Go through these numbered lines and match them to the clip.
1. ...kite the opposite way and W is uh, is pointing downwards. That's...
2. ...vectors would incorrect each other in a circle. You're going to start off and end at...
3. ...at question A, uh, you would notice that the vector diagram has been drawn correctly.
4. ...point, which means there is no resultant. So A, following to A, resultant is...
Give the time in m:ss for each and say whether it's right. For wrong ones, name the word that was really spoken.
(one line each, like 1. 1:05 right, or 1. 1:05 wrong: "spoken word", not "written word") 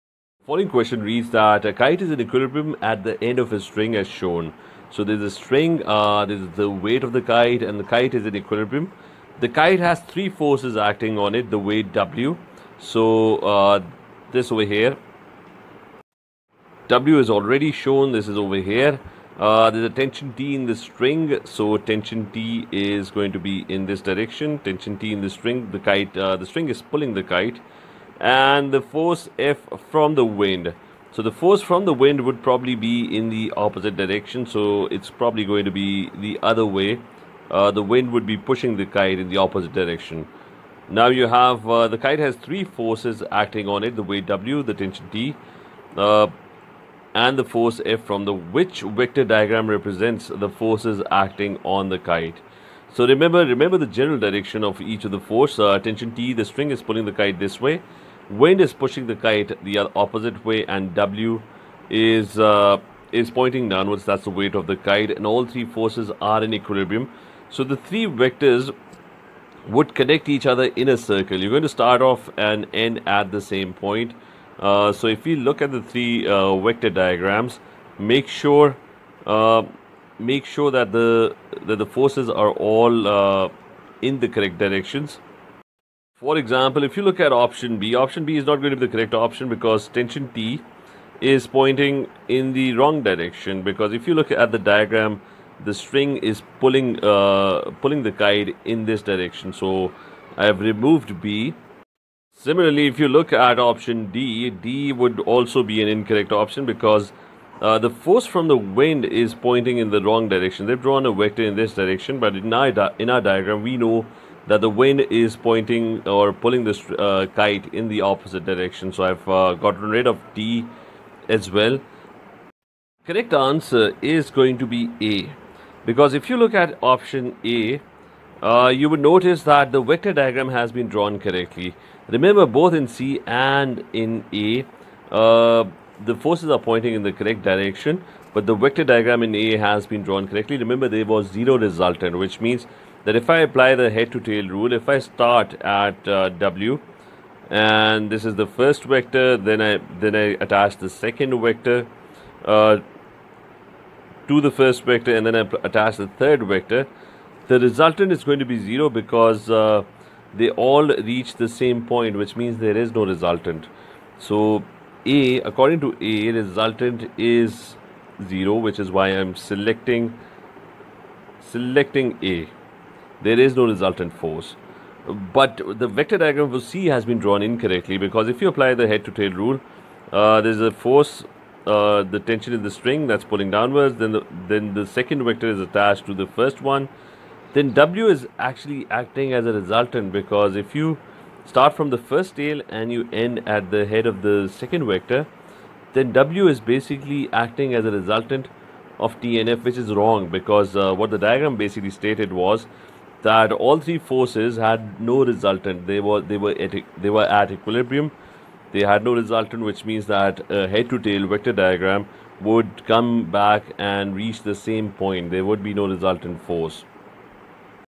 1. 0:59 right
2. 1:08 wrong: "connect", not "incorrect"
3. 2:06 wrong: "option", not "question"
4. 2:41 wrong: "according", not "following".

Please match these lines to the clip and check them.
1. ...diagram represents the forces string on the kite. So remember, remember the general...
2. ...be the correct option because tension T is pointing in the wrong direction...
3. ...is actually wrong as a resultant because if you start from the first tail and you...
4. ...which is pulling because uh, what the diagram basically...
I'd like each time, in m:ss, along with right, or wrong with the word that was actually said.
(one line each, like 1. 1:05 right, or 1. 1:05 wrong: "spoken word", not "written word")
1. 0:49 wrong: "acting", not "string"
2. 1:28 right
3. 3:08 wrong: "acting", not "wrong"
4. 3:19 wrong: "wrong", not "pulling".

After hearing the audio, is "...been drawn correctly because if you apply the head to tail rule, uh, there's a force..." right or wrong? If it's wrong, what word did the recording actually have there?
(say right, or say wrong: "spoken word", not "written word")
wrong: "incorrectly", not "correctly".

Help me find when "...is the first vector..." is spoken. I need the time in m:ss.
2:28.